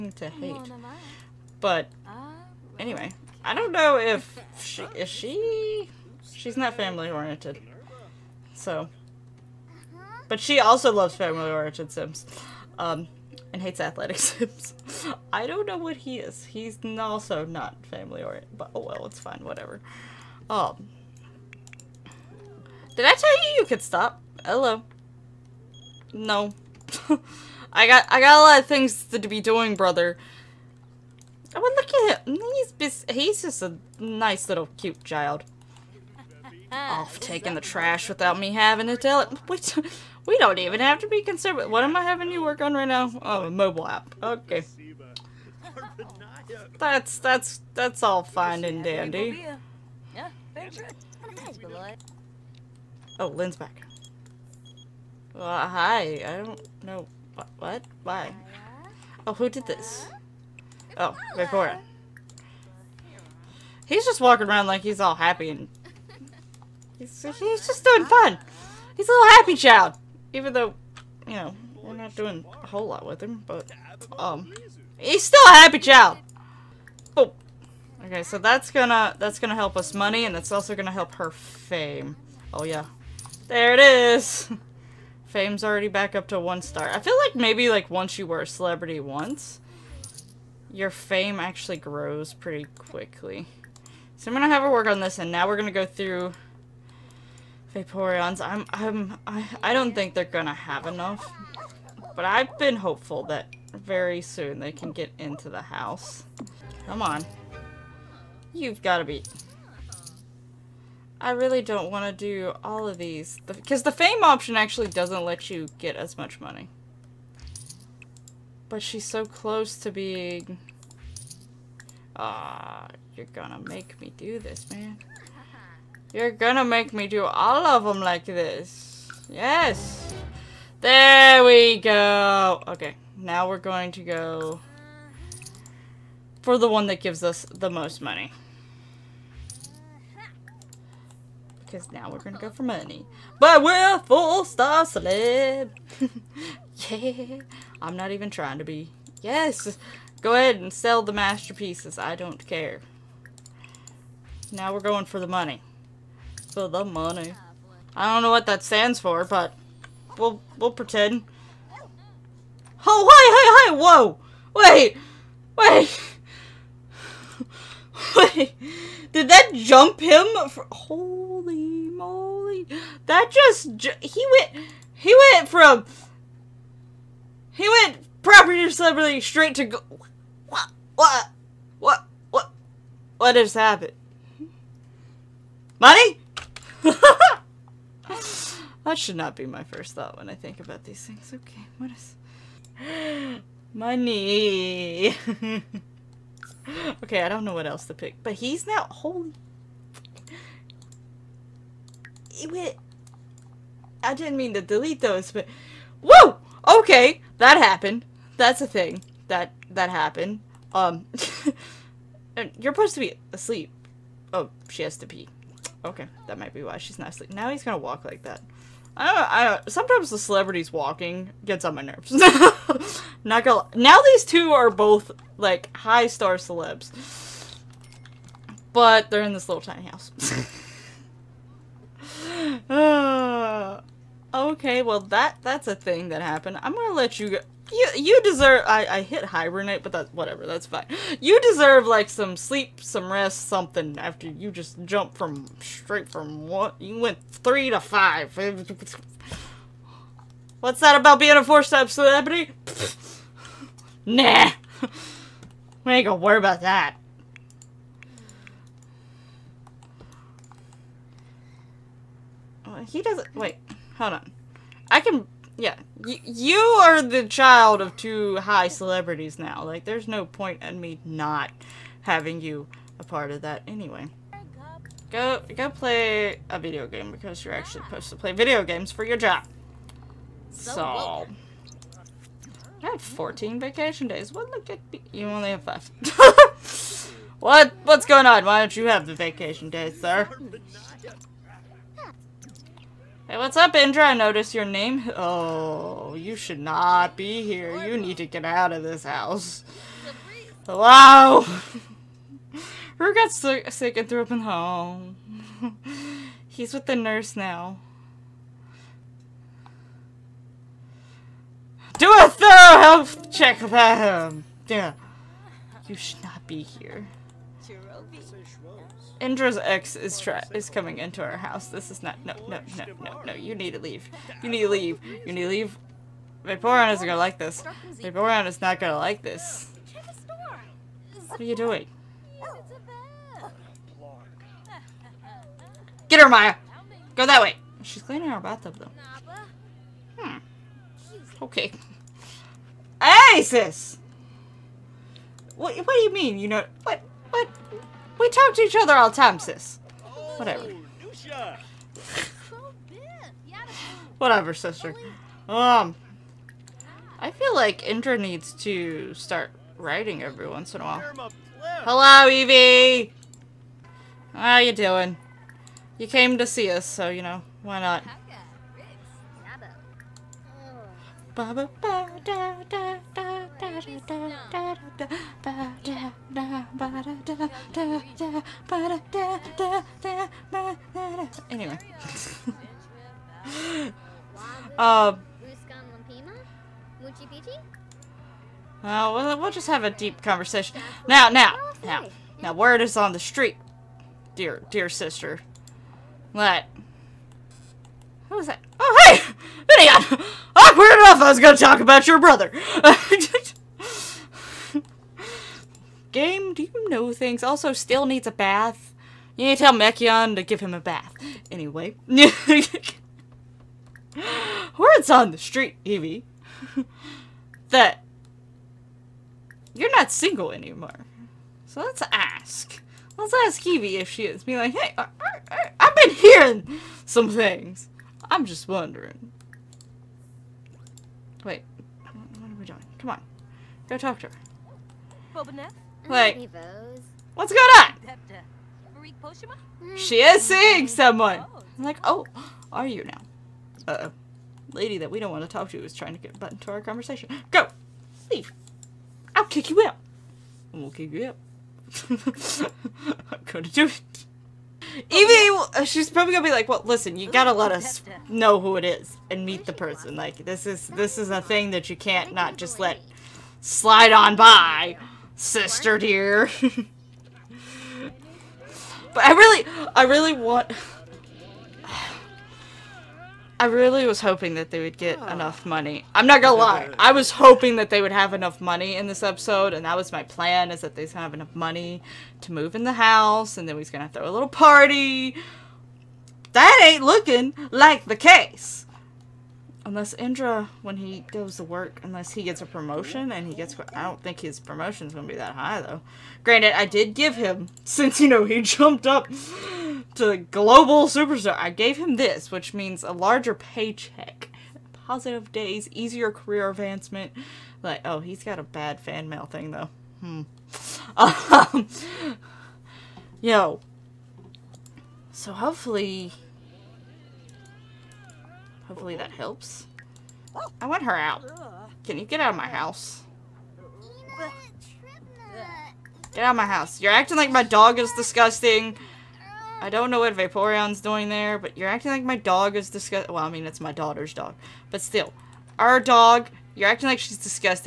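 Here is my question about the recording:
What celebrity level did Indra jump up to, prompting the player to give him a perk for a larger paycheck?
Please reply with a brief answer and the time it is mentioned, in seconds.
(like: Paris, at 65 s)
Global superstar, at 500 s.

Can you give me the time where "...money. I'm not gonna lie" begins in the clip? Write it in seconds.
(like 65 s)
475 s.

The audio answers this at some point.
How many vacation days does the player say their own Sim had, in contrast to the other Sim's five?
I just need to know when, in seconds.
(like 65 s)
283 s.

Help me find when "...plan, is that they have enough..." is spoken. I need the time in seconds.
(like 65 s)
480 s.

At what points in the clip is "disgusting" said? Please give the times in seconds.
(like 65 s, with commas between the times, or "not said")
528 s, 532 s.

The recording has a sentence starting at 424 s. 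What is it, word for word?
Be like, hey, I, have been hearing some things.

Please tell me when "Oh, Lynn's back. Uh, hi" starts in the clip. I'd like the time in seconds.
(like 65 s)
53 s.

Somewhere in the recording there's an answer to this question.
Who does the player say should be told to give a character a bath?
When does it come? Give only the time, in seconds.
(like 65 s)
409 s.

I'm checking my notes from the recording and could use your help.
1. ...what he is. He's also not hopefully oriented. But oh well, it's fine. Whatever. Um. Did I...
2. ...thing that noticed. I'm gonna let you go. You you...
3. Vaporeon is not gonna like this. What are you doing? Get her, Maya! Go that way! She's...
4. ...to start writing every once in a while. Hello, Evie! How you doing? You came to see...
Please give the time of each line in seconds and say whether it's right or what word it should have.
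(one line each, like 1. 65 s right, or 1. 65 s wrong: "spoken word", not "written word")
1. 15 s wrong: "family", not "hopefully"
2. 235 s wrong: "happened", not "noticed"
3. 328 s right
4. 358 s right.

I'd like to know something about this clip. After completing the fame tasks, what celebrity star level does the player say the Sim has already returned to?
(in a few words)
1 star.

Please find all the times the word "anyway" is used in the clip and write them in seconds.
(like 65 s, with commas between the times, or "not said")
2 s, 273 s, 373 s, 411 s.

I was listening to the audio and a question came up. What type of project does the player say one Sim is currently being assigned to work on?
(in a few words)
A mobile app.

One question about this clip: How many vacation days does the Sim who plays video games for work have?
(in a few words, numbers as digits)
5.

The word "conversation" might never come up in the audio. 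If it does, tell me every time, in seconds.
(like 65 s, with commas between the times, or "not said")
390 s, 446 s.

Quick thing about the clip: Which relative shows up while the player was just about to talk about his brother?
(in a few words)
Gideon.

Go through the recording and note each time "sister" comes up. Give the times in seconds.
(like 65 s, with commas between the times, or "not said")
354 s, 394 s, 465 s.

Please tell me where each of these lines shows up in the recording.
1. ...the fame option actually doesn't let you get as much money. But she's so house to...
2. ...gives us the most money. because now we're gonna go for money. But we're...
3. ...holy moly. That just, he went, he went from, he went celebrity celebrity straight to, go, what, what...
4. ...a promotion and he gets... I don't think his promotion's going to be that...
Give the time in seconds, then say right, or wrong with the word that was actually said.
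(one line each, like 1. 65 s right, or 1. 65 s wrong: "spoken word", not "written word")
1. 113 s wrong: "close", not "house"
2. 136 s right
3. 171 s wrong: "property", not "celebrity"
4. 492 s right.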